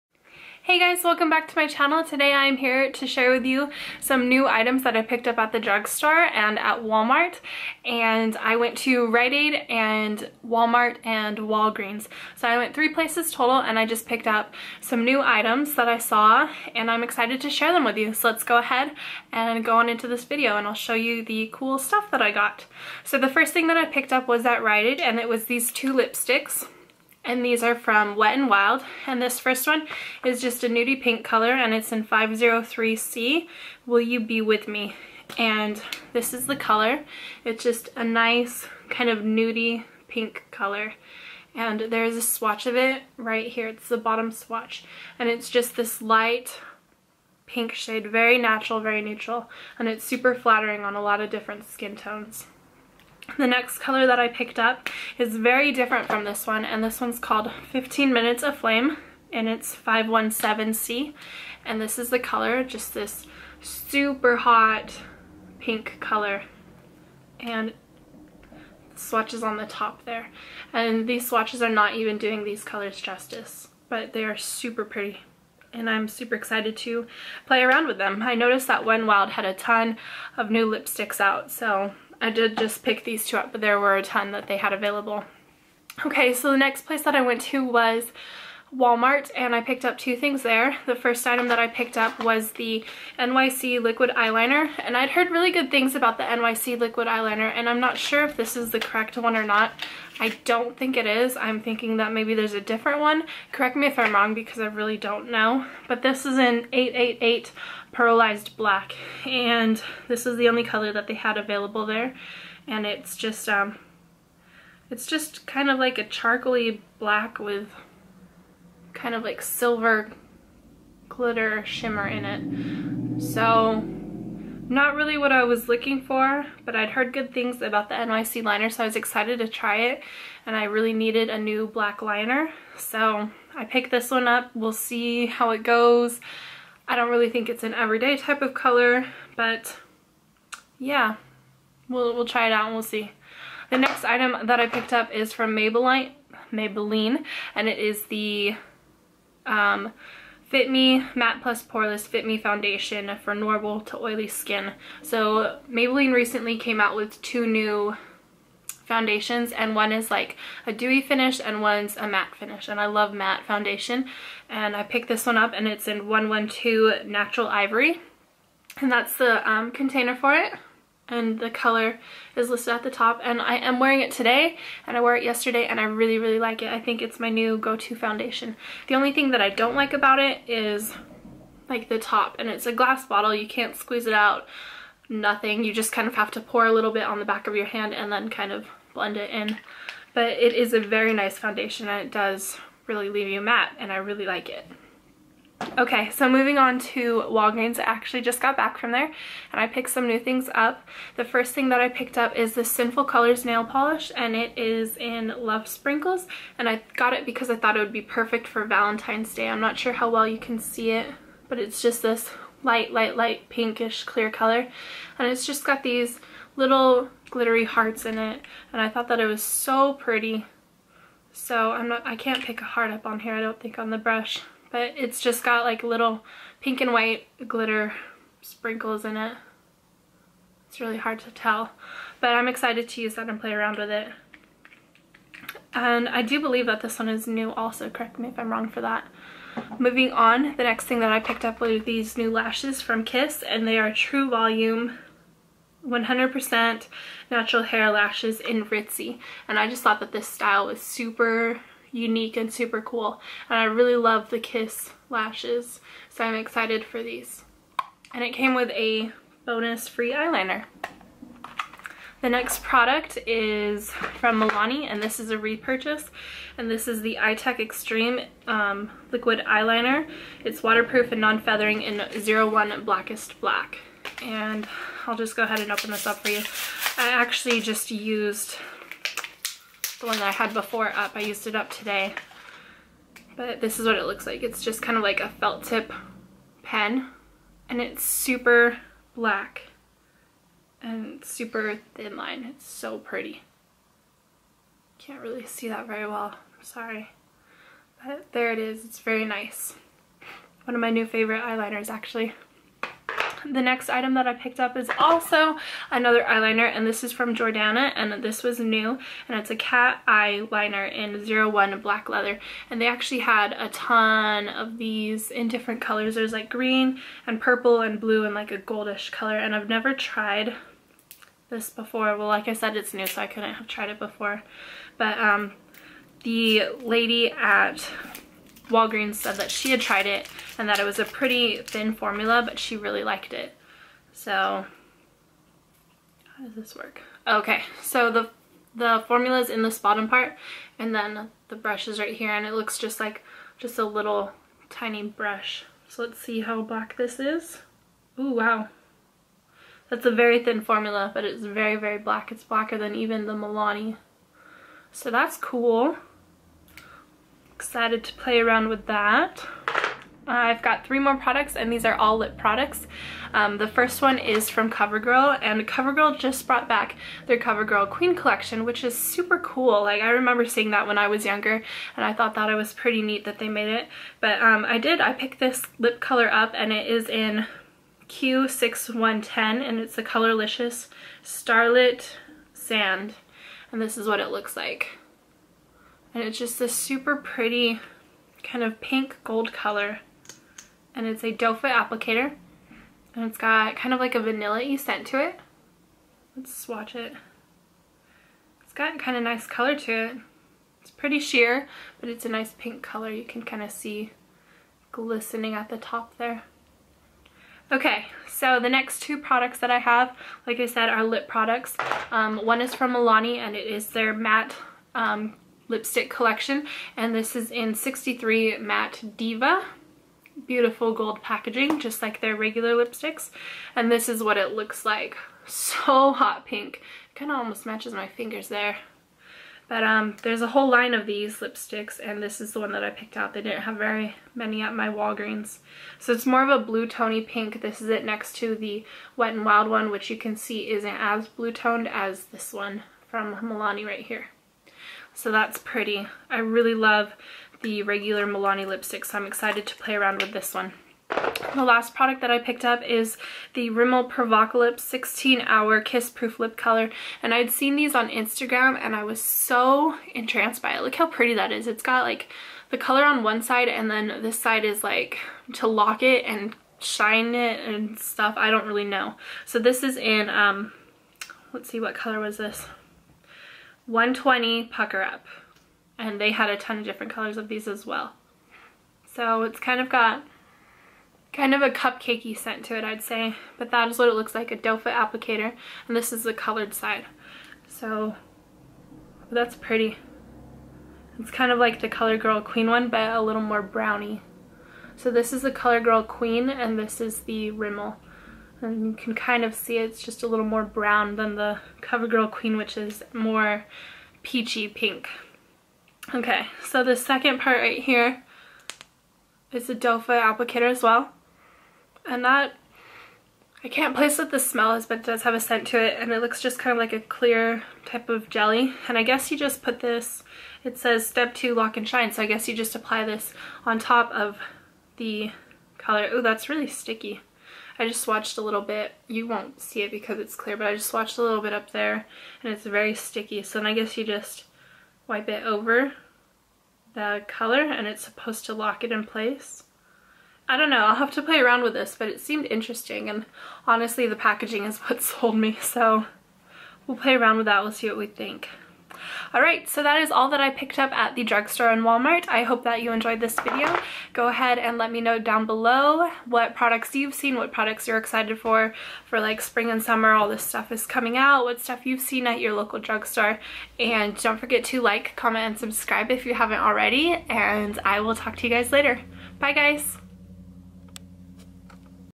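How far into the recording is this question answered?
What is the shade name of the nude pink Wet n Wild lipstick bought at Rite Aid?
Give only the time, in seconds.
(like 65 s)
33 s.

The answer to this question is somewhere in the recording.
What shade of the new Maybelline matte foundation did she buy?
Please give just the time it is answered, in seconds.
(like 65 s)
166 s.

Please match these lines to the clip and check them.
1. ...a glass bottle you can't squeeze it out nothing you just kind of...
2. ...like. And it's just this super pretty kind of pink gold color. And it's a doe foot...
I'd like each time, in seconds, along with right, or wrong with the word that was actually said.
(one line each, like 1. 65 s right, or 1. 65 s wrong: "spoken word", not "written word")
1. 182 s right
2. 384 s right.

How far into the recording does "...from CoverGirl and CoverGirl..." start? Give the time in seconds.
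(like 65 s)
364 s.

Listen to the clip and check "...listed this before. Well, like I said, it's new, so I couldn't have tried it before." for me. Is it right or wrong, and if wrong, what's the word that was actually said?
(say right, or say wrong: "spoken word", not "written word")
wrong: "tried", not "listed".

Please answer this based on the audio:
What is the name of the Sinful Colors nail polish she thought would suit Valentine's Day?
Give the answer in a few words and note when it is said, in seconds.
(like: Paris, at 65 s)
Love Sprinkles, at 205 s.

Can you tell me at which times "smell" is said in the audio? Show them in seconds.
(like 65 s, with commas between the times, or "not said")
514 s.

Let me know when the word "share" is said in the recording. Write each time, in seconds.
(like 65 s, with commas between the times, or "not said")
3 s, 17 s.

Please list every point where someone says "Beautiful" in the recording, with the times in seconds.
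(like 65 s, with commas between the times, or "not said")
420 s.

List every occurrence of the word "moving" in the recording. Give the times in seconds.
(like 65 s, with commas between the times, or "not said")
196 s, 239 s.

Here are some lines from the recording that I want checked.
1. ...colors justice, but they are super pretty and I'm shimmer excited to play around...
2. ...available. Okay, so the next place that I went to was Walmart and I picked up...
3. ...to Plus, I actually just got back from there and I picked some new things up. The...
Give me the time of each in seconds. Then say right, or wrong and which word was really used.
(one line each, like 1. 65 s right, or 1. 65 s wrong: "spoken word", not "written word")
1. 72 s wrong: "super", not "shimmer"
2. 84 s right
3. 196 s wrong: "Walgreens", not "Plus".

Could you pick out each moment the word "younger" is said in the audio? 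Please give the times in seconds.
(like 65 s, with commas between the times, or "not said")
371 s.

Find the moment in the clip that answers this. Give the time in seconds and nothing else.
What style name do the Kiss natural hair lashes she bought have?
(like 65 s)
248 s.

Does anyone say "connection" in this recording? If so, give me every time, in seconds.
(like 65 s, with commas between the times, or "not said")
not said.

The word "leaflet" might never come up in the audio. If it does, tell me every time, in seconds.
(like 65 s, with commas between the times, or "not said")
not said.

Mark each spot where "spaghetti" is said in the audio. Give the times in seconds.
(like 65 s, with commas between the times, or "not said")
not said.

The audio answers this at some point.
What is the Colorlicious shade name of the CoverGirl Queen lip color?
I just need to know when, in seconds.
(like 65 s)
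381 s.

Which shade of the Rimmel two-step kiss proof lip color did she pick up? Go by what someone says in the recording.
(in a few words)
120 Pucker Up.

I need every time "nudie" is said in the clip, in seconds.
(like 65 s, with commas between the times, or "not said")
30 s, 39 s.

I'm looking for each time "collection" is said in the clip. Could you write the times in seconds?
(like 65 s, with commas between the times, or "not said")
368 s, 416 s.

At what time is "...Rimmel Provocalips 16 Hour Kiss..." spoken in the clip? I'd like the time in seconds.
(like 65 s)
453 s.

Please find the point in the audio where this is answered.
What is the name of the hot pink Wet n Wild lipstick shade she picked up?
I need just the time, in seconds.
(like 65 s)
57 s.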